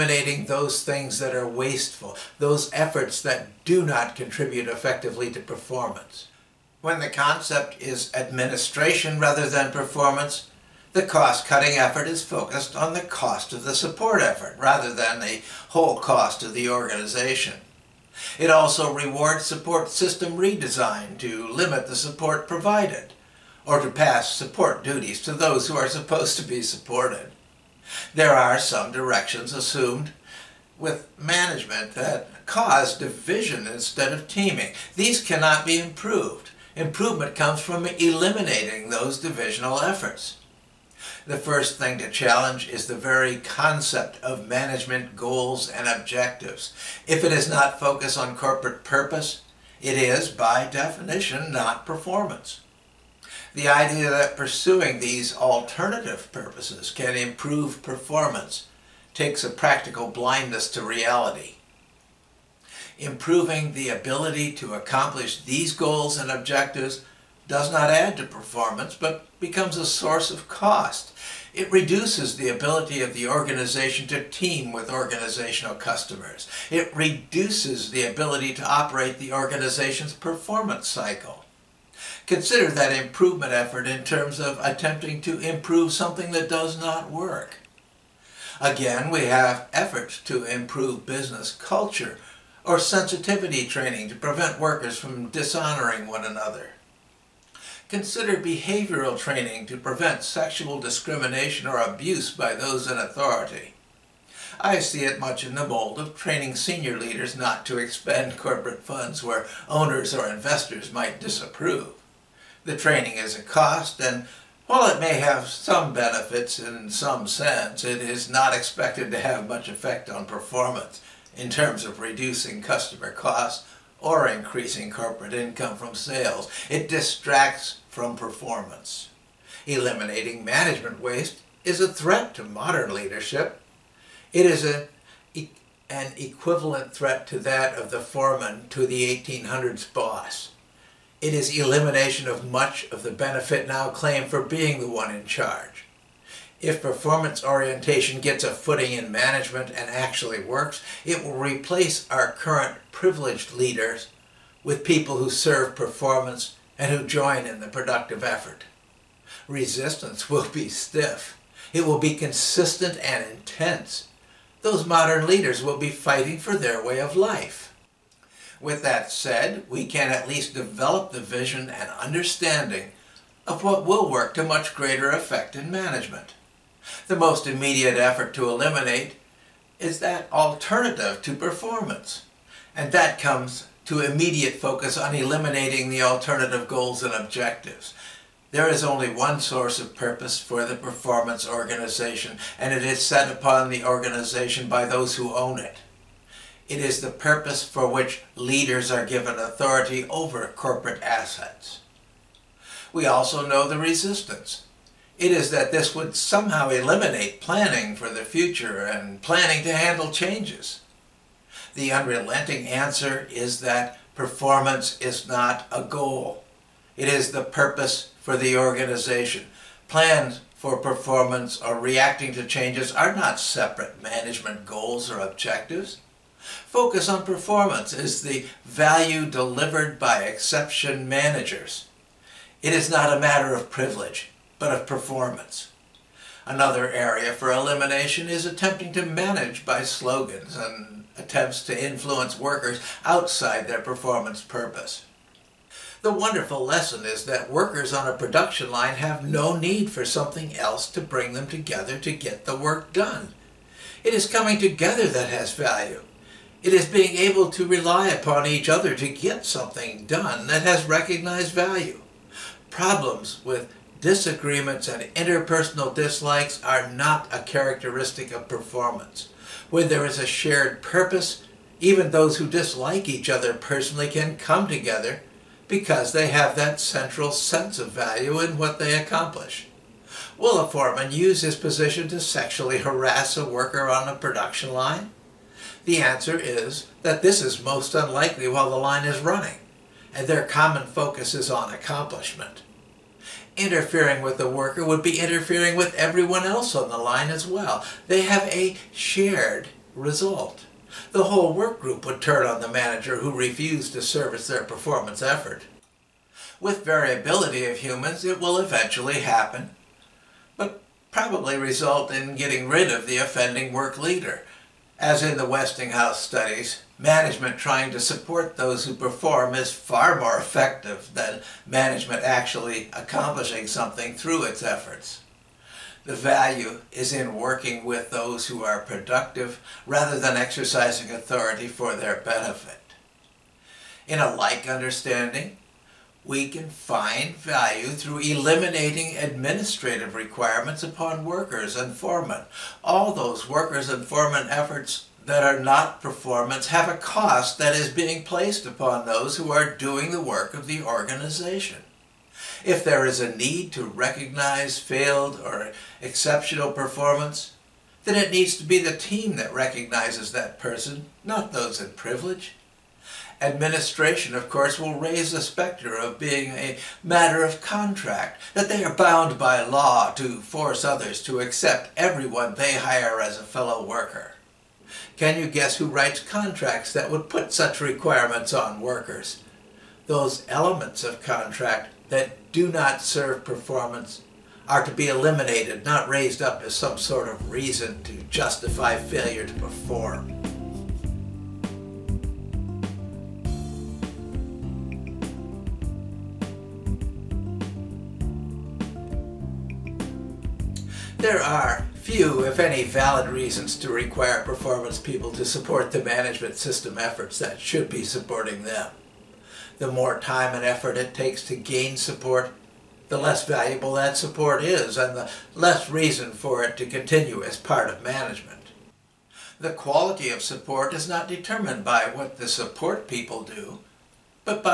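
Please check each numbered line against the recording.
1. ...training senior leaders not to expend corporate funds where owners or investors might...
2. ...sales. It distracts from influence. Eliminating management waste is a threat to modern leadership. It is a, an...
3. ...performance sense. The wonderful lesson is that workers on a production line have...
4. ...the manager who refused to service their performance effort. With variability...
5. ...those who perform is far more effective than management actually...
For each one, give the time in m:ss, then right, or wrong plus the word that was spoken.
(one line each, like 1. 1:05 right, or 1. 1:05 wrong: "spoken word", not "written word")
1. 1:46 right
2. 2:05 wrong: "performance", not "influence"
3. 4:03 wrong: "purpose", not "sense"
4. 5:02 right
5. 5:18 right.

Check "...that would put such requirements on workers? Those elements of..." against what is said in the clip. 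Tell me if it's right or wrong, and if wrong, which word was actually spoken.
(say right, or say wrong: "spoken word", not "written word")
right.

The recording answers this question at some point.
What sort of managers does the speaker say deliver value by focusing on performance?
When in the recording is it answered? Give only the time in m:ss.
3:50.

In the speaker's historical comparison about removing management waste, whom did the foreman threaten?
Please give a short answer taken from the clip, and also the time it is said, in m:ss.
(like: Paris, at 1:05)
the 1800s boss, at 2:19.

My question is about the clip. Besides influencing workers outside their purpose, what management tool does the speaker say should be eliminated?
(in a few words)
slogans.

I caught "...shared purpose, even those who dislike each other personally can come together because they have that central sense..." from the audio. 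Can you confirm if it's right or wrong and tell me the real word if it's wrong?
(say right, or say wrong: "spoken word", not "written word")
right.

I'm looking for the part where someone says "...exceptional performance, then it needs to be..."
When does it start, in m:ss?
5:56.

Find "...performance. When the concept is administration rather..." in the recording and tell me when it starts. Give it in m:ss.
0:05.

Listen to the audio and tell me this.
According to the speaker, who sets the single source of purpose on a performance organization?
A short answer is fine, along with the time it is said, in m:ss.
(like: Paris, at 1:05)
those who own it, at 3:14.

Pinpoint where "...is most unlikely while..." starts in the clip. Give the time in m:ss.
4:47.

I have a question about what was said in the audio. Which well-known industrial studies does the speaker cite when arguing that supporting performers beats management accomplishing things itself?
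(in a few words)
Westinghouse studies.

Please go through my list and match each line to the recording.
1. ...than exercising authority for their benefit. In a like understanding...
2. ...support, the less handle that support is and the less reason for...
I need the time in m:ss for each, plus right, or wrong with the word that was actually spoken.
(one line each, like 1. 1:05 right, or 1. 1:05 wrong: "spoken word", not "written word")
1. 5:30 right
2. 6:51 wrong: "valuable", not "handle".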